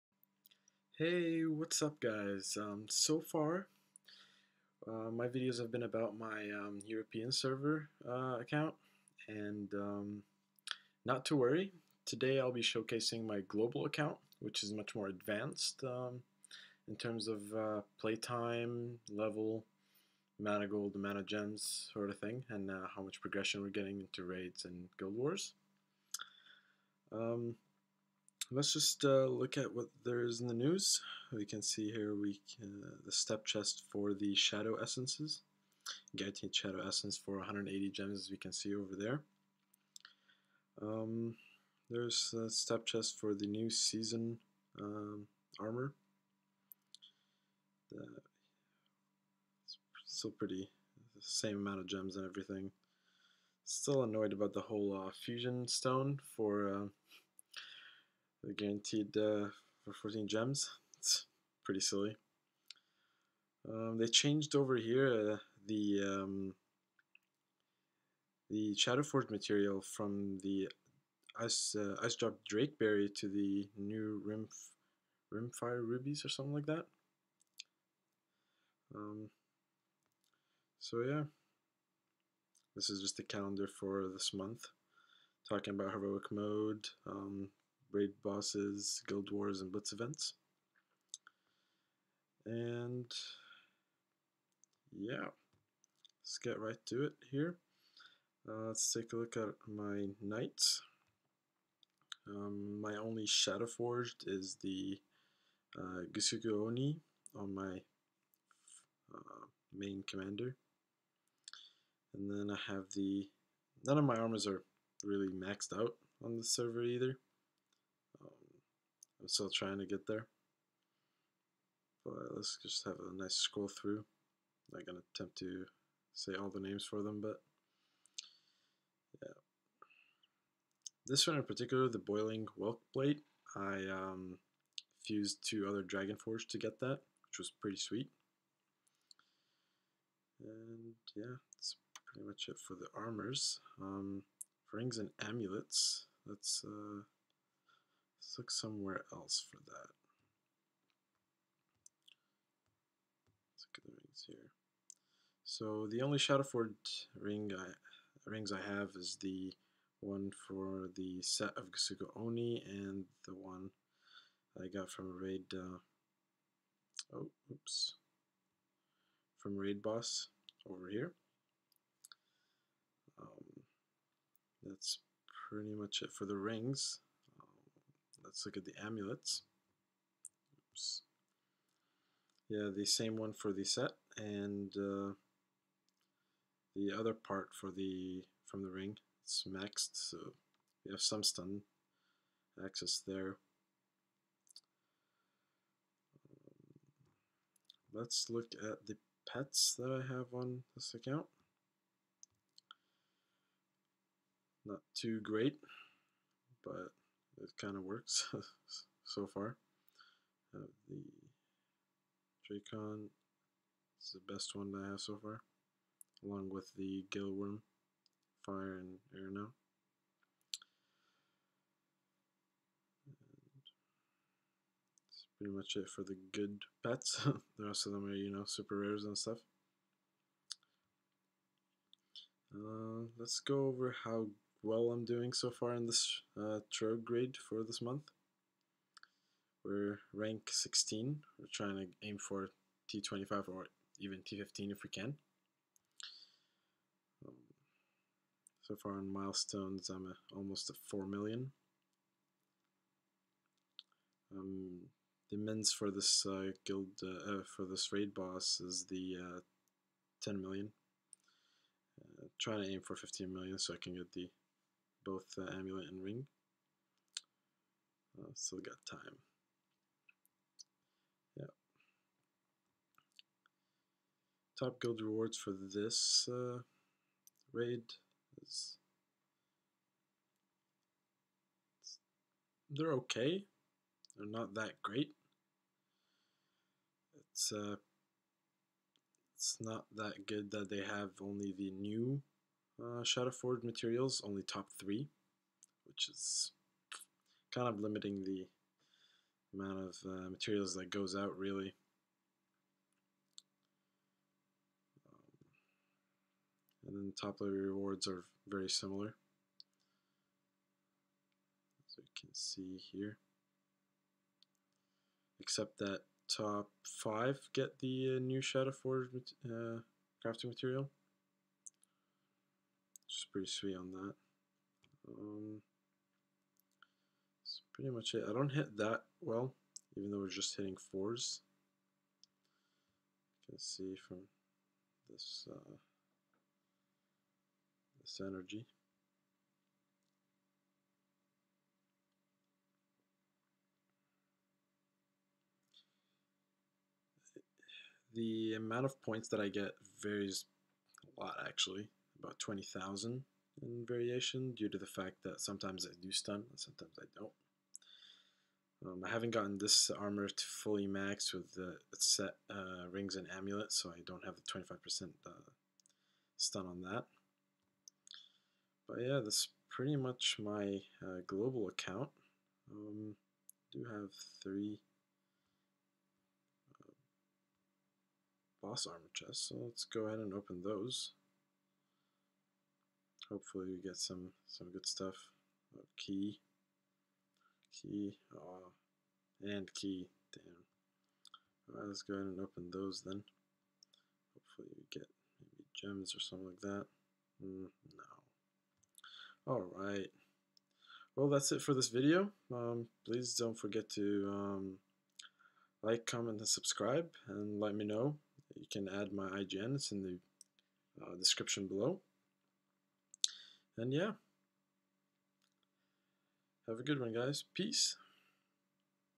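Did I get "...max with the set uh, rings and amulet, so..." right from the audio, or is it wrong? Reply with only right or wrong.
right.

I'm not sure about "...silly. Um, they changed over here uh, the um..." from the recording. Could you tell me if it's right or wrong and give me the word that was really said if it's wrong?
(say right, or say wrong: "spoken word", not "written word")
right.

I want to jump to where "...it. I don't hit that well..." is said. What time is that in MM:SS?
05:28.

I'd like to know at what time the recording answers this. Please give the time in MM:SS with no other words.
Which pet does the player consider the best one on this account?
03:32.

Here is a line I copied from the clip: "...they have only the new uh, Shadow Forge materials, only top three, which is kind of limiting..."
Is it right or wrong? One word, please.
right.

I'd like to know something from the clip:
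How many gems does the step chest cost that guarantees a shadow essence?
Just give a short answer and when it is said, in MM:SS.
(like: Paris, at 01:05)
180, at 00:37.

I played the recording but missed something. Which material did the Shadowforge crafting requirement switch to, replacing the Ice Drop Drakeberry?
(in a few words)
Rimfire Rubies.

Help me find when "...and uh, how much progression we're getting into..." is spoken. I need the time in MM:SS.
00:22.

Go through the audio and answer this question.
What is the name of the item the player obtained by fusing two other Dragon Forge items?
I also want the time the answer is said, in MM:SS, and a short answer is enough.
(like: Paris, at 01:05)
Boiling Whelk Blade, at 02:11.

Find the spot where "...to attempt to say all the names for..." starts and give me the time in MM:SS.
02:04.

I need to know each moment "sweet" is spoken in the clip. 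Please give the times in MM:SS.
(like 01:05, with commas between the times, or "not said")
02:17, 05:23.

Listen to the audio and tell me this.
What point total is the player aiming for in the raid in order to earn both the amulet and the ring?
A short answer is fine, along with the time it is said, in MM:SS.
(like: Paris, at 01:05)
15 million, at 04:22.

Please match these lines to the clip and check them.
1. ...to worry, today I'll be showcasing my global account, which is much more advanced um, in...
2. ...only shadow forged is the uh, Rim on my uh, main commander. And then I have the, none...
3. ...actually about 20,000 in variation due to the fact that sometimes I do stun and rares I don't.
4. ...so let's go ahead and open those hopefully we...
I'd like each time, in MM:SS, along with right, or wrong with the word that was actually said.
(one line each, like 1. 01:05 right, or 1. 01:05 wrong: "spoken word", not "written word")
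1. 00:11 right
2. 01:42 wrong: "Oni", not "Rim"
3. 05:51 wrong: "sometimes", not "rares"
4. 06:19 right.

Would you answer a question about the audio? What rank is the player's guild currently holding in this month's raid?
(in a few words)
16.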